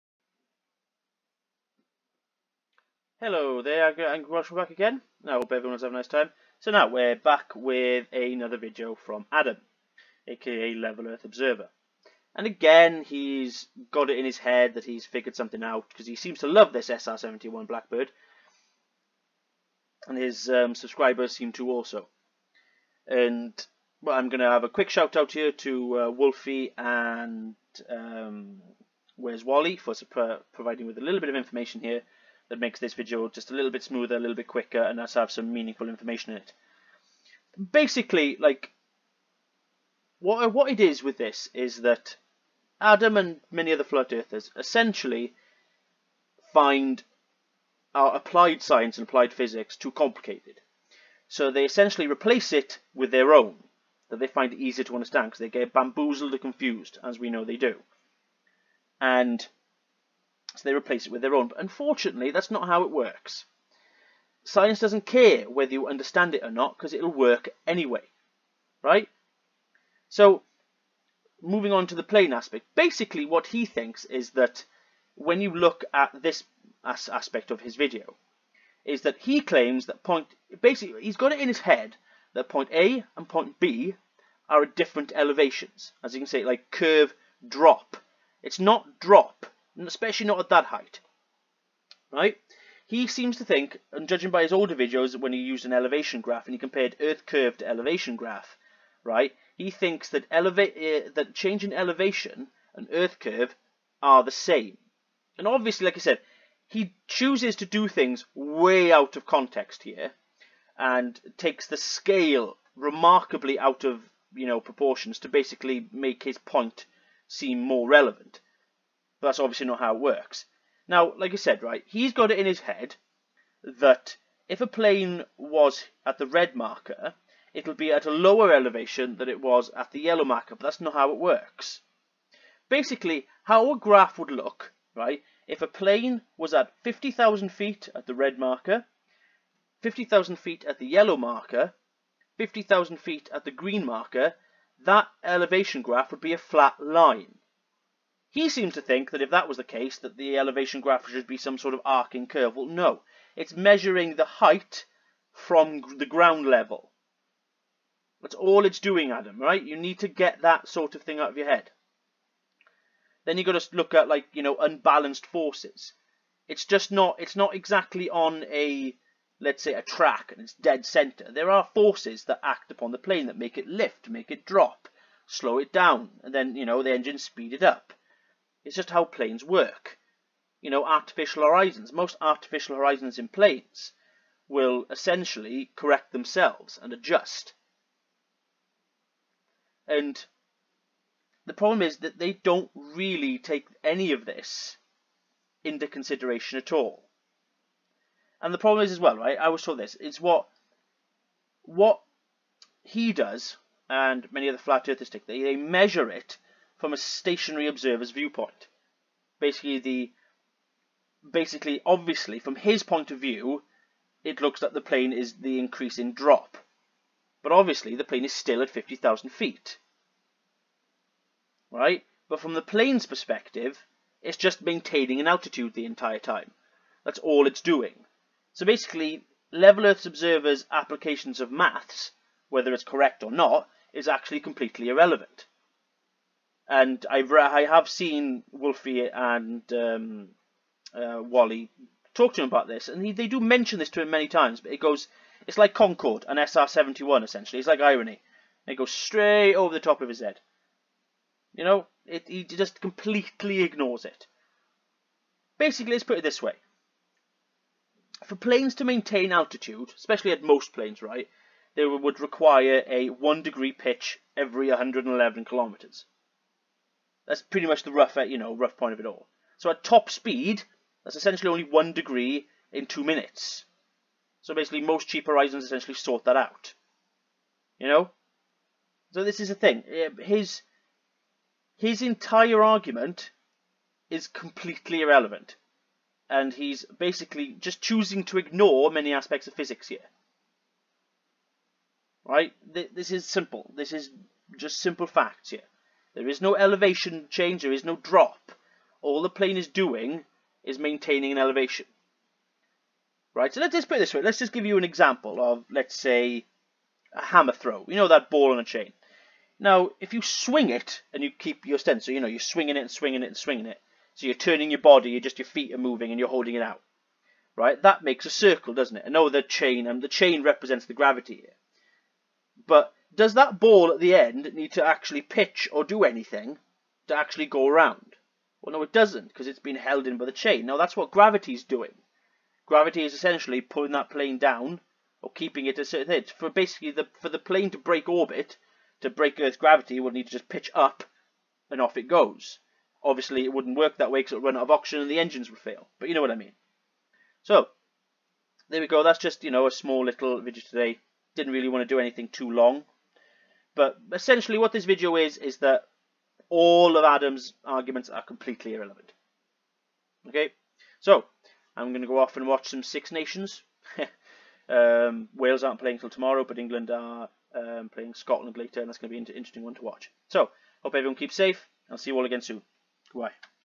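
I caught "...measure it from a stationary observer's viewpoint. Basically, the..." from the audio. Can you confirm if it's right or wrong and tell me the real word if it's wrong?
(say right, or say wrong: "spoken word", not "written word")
right.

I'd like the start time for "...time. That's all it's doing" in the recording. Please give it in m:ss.
3:46.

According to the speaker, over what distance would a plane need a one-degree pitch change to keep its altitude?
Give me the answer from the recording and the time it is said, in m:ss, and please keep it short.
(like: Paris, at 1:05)
111 kilometers, at 4:24.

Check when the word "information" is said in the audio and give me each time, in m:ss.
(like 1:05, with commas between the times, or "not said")
0:31, 0:35.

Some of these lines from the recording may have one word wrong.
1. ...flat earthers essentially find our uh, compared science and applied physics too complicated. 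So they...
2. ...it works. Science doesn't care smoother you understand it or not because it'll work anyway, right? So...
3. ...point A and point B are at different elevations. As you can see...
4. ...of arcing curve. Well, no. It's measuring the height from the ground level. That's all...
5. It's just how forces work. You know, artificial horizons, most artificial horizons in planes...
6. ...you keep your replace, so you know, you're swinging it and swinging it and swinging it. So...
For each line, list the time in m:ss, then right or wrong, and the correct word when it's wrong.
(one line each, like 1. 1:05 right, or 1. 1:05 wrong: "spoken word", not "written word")
1. 0:43 wrong: "applied", not "compared"
2. 1:02 wrong: "whether", not "smoother"
3. 1:22 right
4. 2:31 right
5. 2:58 wrong: "planes", not "forces"
6. 5:11 wrong: "stance", not "replace".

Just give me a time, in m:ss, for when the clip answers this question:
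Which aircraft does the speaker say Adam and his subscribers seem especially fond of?
0:16.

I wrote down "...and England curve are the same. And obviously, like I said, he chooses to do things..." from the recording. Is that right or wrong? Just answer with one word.
wrong.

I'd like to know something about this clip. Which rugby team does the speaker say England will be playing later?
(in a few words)
Scotland.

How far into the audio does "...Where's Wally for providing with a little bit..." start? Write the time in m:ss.
0:29.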